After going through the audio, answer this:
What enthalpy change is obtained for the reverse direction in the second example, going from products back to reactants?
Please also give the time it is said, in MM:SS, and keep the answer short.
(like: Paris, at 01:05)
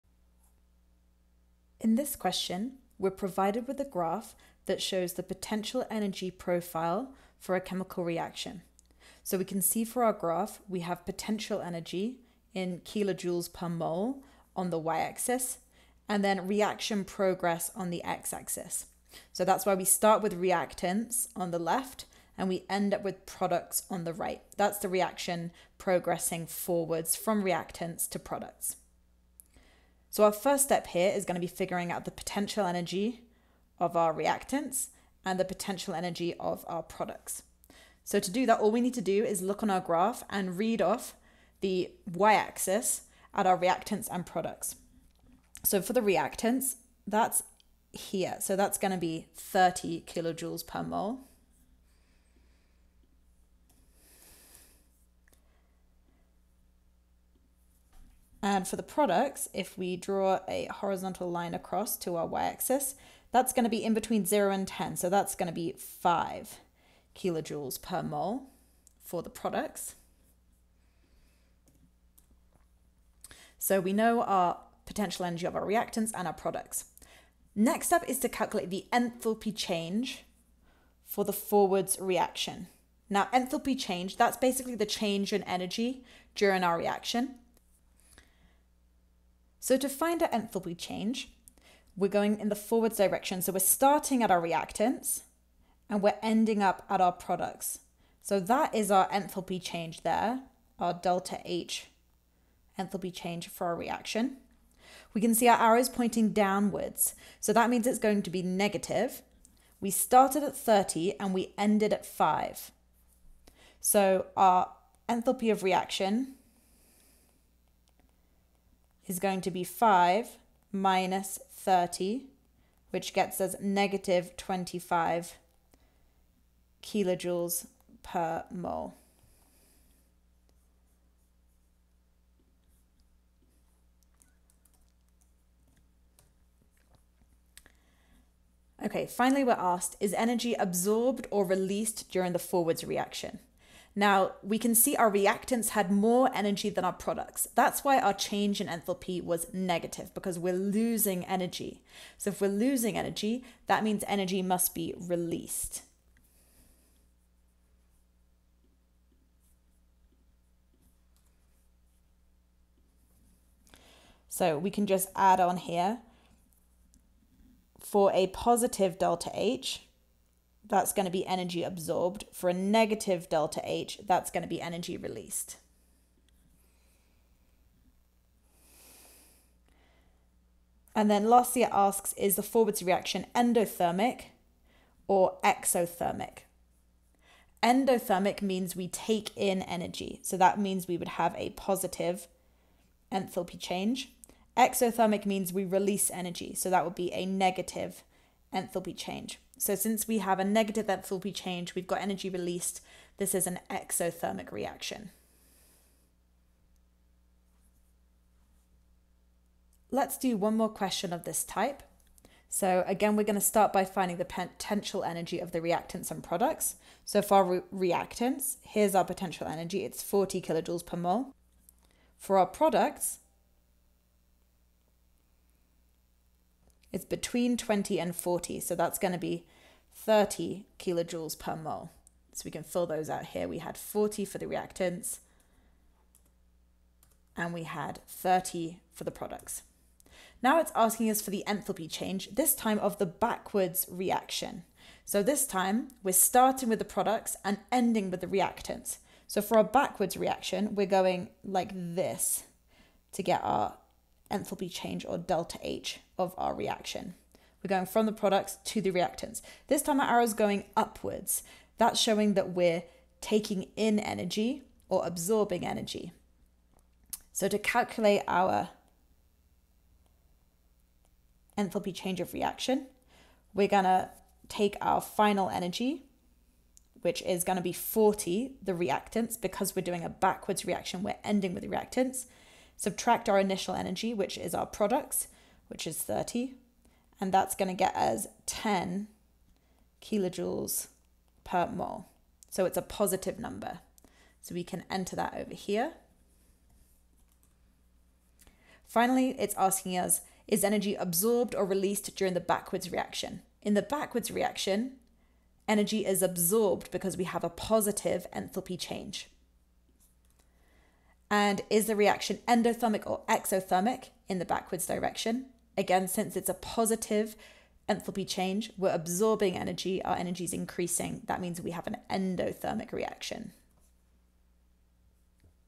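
10 kJ/mol, at 04:48.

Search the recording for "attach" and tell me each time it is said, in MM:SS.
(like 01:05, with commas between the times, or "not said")
not said.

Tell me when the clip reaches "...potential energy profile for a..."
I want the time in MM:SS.
00:05.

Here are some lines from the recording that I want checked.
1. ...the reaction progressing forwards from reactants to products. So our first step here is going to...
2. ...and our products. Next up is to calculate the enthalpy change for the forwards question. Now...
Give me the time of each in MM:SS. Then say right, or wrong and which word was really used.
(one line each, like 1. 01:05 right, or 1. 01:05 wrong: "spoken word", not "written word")
1. 00:24 right
2. 01:16 wrong: "reaction", not "question".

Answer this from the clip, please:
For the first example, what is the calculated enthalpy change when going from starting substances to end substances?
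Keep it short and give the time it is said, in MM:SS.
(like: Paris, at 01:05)
-25 kJ/mol, at 02:03.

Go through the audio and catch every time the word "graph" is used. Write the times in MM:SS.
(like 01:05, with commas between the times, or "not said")
00:03, 00:10, 00:39.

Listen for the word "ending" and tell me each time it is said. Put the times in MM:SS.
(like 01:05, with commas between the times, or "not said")
01:36, 04:07, 04:41.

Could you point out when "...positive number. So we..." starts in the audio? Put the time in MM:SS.
04:52.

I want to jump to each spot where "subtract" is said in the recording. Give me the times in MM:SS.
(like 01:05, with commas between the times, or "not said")
04:42.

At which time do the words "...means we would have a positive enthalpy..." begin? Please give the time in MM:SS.
03:10.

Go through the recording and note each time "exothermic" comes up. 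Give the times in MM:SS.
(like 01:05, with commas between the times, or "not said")
03:05, 03:14, 03:23, 05:13.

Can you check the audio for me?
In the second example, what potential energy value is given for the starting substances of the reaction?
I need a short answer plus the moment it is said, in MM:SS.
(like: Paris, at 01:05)
40 kJ/mol, at 03:40.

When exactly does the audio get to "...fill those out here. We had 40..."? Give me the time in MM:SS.
03:52.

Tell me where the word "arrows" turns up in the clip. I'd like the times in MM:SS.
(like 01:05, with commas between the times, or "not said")
01:45, 04:20.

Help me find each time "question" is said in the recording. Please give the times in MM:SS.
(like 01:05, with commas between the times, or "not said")
00:02, 03:30.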